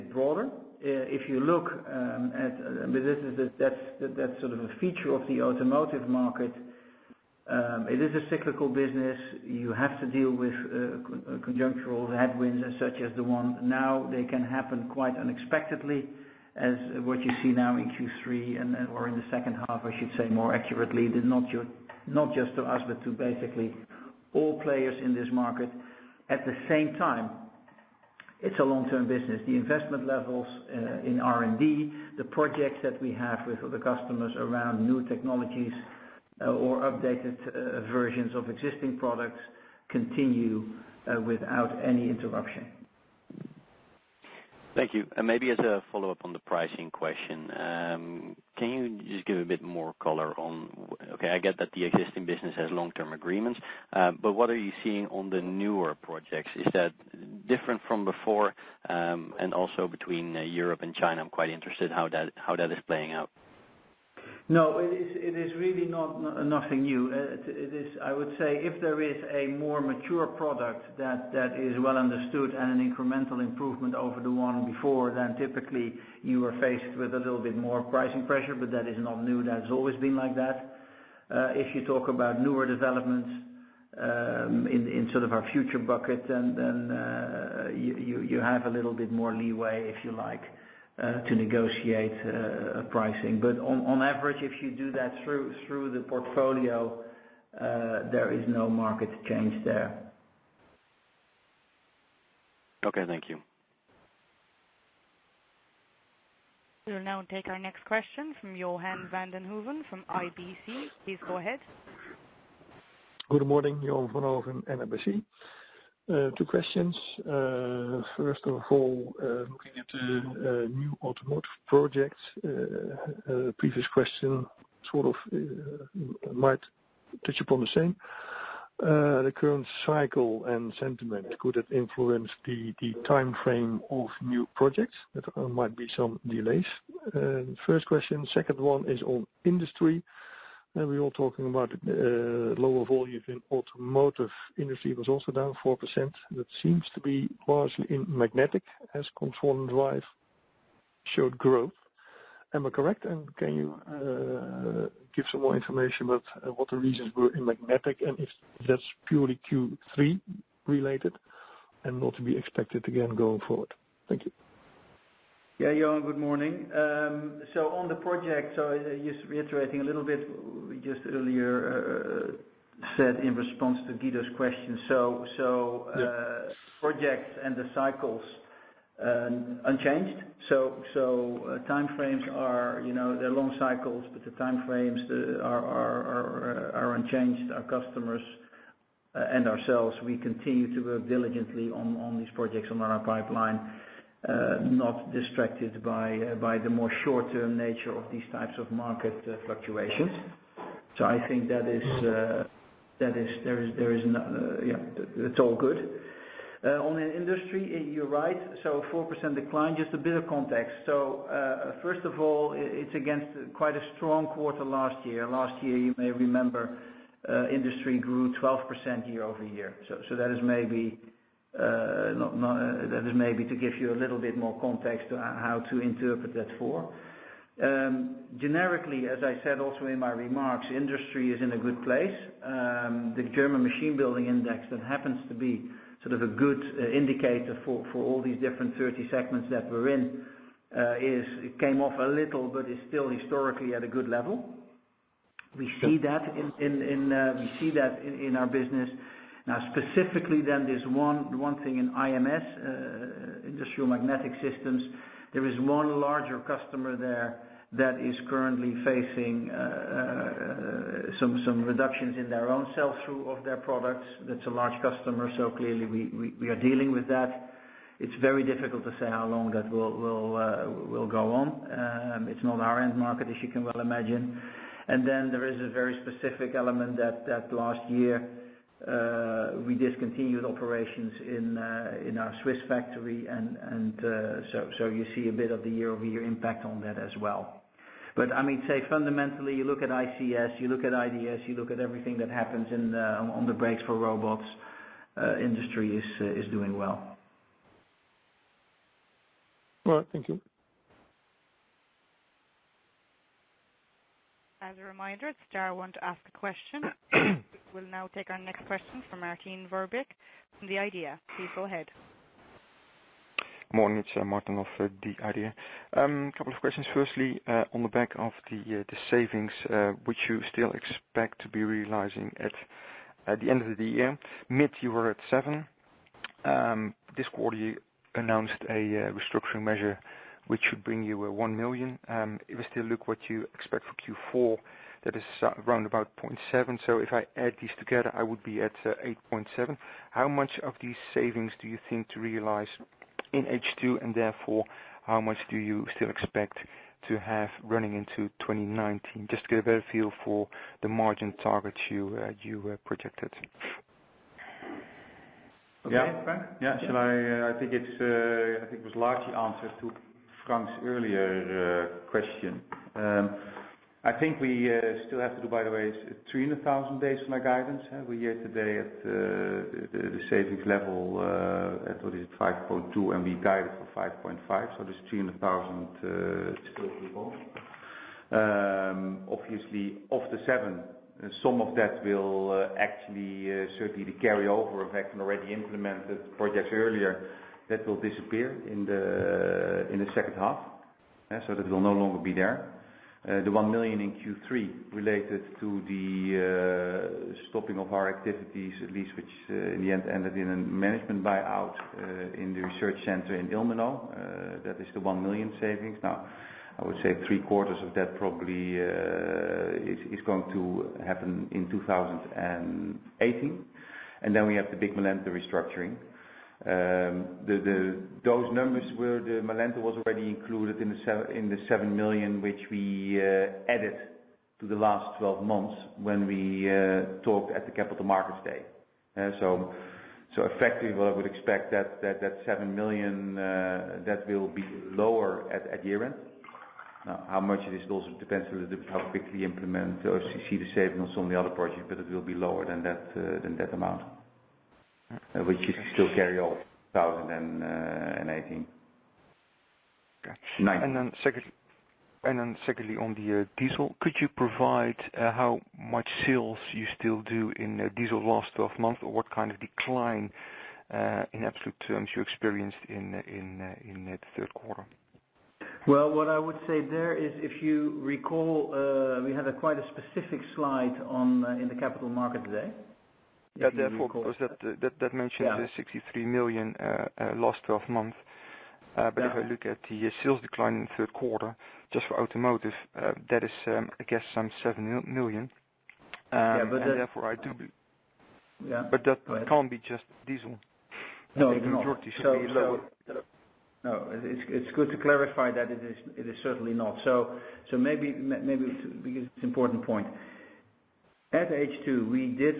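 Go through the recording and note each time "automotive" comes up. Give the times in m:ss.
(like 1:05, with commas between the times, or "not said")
0:05, 2:01, 2:23, 8:02.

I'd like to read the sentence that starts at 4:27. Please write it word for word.
It's very difficult to say how long that will, will, uh, will go on.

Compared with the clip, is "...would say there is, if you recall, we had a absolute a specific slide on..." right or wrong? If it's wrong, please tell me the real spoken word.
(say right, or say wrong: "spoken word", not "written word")
wrong: "quite", not "absolute".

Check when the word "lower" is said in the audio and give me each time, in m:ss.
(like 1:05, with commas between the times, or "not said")
2:22, 7:14, 7:22.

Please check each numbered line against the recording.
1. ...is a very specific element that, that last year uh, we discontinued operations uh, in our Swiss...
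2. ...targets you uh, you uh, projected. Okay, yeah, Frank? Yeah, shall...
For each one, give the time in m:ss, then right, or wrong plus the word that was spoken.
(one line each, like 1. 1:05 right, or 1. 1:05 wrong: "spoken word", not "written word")
1. 4:35 right
2. 5:51 right.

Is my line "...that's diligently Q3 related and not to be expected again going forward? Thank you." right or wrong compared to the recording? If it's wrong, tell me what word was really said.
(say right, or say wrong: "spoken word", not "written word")
wrong: "purely", not "diligently".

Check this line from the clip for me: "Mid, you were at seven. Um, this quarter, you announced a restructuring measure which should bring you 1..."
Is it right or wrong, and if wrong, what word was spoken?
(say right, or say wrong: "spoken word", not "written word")
right.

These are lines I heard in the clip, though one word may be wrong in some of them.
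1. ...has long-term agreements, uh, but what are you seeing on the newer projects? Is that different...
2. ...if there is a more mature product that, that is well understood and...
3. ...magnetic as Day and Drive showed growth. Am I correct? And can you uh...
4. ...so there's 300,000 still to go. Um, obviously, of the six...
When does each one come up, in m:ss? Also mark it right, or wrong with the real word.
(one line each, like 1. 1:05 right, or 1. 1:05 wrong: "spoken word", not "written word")
1. 0:52 right
2. 1:08 right
3. 2:28 wrong: "Control", not "Day"
4. 6:14 wrong: "seven", not "six".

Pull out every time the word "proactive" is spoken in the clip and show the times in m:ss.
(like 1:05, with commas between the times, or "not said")
not said.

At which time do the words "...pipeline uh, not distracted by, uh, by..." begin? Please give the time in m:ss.
3:13.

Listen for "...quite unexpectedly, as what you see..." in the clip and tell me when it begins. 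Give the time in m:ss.
0:14.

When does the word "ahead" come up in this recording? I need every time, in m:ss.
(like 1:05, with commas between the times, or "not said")
1:51, 5:11.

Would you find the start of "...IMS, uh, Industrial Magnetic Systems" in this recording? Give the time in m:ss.
4:11.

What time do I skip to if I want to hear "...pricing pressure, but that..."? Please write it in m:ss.
1:17.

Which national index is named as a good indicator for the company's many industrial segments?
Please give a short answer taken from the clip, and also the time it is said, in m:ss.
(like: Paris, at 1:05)
German machine building index, at 3:53.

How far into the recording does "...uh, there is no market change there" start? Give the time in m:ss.
1:37.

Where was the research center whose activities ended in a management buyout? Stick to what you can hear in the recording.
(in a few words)
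Ilmenau.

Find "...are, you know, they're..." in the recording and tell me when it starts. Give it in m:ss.
3:02.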